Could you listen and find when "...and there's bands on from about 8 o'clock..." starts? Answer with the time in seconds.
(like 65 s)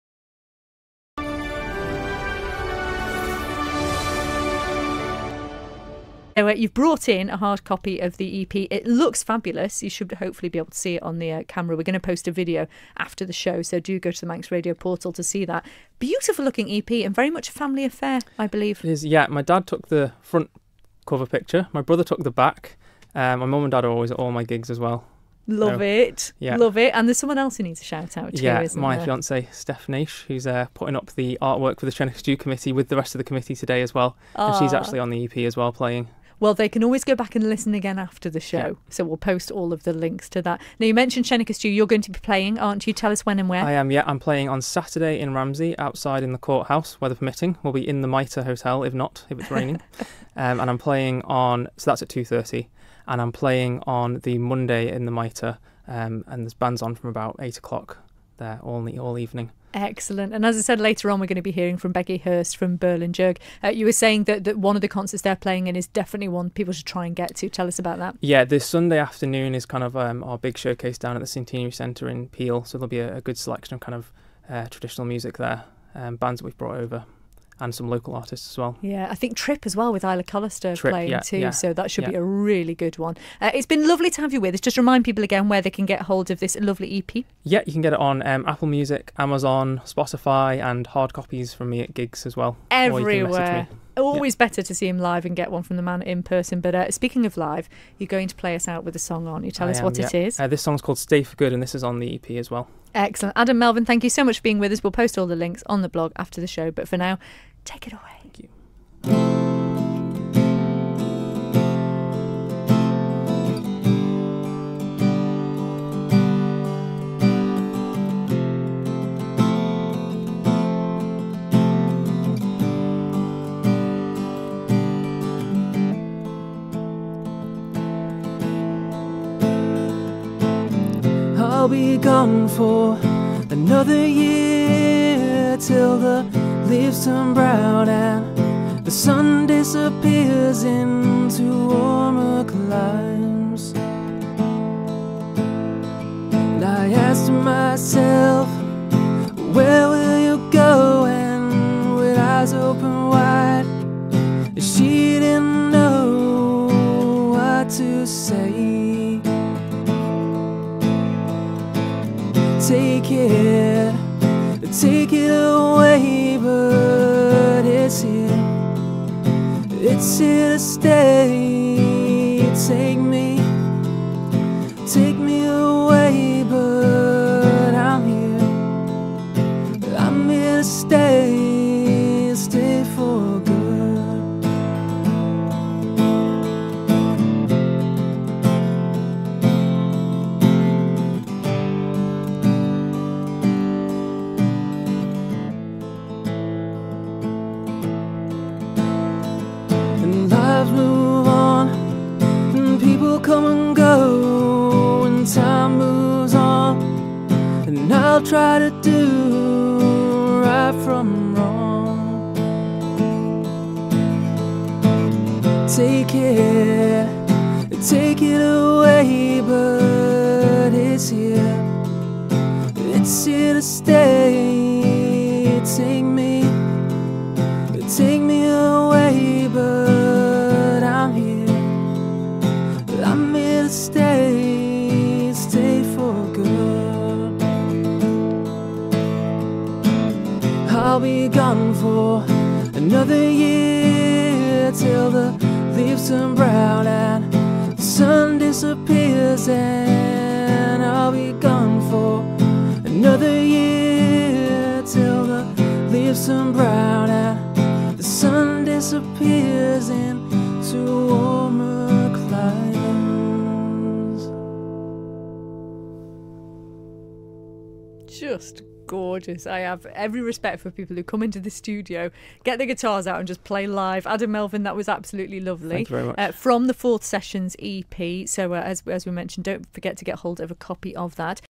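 56 s.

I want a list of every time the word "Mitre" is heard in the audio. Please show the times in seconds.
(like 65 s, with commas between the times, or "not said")
48 s, 55 s.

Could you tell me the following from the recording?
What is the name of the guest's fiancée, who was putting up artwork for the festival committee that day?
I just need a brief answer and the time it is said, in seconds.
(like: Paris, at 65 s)
Steph Nash, at 29 s.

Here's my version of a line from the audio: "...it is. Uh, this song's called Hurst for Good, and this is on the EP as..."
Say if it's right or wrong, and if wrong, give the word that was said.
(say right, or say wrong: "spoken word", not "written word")
wrong: "Stay", not "Hurst".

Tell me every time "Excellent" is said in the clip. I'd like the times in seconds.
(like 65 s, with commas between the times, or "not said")
59 s, 102 s.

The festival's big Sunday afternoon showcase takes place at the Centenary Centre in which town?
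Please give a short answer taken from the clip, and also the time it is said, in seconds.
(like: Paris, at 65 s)
Peel, at 72 s.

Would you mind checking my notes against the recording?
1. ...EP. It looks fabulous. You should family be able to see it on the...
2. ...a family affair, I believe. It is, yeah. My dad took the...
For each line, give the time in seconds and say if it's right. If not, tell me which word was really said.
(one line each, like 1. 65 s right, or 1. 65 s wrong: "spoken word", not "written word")
1. 8 s wrong: "hopefully", not "family"
2. 17 s right.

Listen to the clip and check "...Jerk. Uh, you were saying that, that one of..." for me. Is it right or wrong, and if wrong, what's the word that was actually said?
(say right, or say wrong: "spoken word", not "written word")
right.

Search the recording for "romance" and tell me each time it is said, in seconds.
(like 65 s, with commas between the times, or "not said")
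not said.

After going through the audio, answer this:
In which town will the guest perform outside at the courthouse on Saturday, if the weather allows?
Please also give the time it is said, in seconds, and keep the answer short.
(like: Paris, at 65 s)
Ramsey, at 45 s.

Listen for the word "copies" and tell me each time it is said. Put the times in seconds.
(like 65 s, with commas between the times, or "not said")
91 s.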